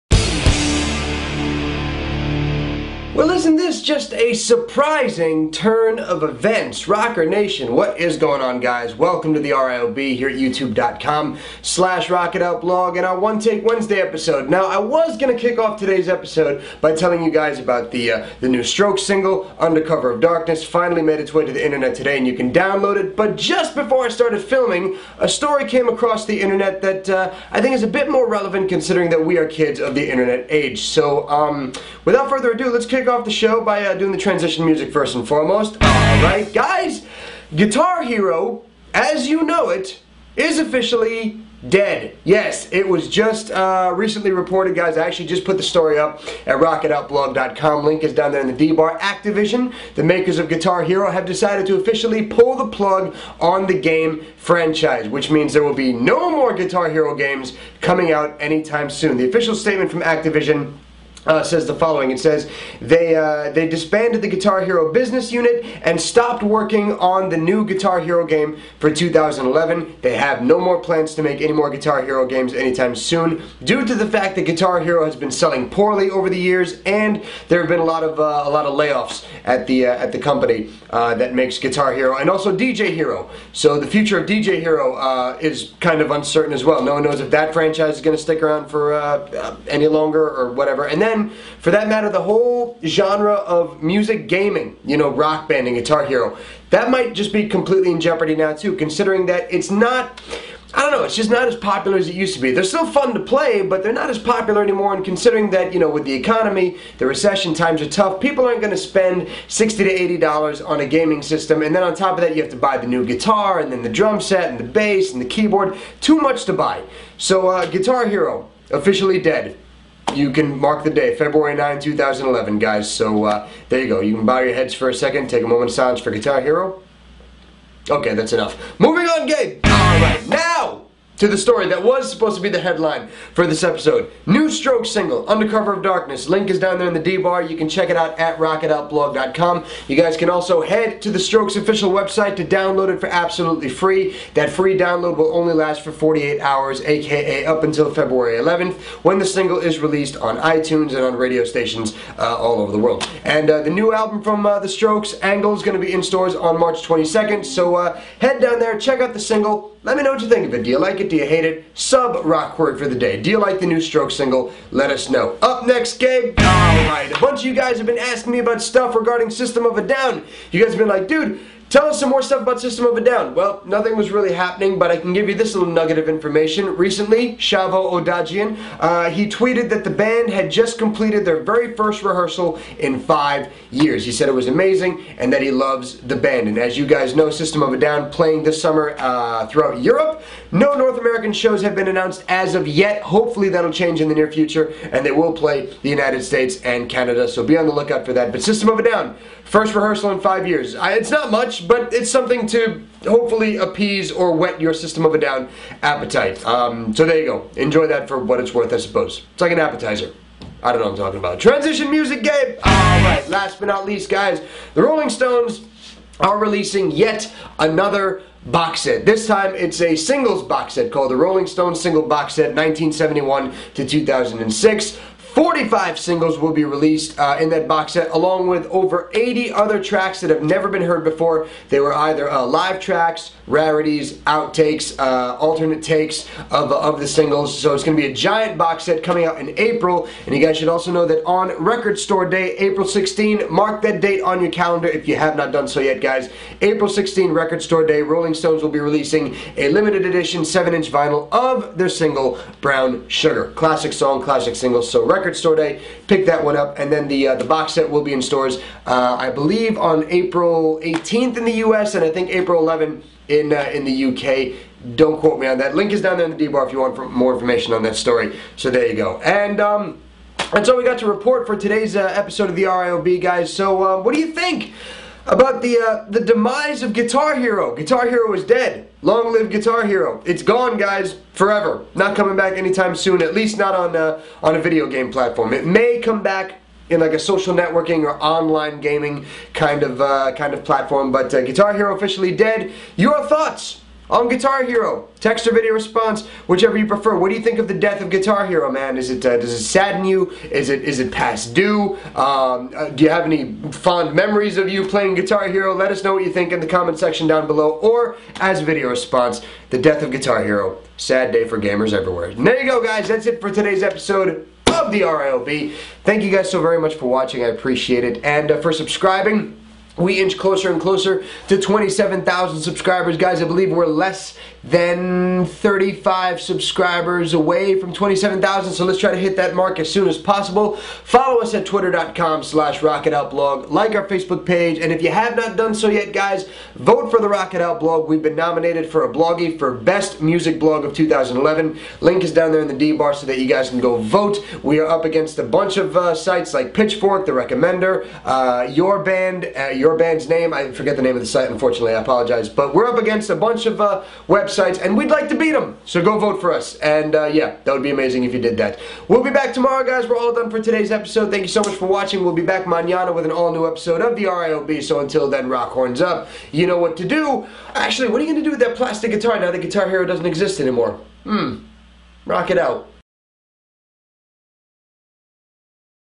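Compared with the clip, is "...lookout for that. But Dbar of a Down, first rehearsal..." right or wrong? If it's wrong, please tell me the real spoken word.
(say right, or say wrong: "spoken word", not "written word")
wrong: "System", not "Dbar".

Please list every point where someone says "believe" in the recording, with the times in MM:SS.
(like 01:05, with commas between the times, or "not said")
04:19, 05:23.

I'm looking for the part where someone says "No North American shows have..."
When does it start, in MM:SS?
03:10.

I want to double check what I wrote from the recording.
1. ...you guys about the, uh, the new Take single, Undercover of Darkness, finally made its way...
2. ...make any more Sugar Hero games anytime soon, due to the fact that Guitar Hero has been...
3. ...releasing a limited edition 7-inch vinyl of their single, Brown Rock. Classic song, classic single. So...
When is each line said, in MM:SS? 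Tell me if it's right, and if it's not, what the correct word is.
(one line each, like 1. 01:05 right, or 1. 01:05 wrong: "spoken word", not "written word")
1. 00:17 wrong: "Stroke", not "Take"
2. 01:11 wrong: "Guitar", not "Sugar"
3. 04:08 wrong: "Sugar", not "Rock".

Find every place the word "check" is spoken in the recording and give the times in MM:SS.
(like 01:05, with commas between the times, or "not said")
02:17, 02:38.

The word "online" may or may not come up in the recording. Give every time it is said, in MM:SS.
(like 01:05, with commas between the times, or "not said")
04:48.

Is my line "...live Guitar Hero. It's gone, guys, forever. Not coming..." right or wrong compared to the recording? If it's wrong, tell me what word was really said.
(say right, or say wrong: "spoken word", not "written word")
right.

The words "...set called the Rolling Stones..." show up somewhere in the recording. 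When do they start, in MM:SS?
03:40.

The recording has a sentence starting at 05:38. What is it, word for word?
We've been nominated for a Bloggie for Best Music Blog of 2011.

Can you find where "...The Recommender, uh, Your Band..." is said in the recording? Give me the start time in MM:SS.
05:47.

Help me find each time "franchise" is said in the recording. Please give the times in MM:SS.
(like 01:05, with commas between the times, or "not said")
00:54, 01:27.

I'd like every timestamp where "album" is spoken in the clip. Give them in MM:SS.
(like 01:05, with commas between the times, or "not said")
02:33.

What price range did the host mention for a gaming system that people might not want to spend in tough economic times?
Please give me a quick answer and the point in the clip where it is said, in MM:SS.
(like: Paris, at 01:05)
$60 to $80, at 01:49.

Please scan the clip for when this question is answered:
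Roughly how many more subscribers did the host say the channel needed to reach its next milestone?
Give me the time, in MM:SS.
05:25.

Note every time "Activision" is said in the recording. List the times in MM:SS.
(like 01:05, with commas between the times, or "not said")
00:48, 01:00.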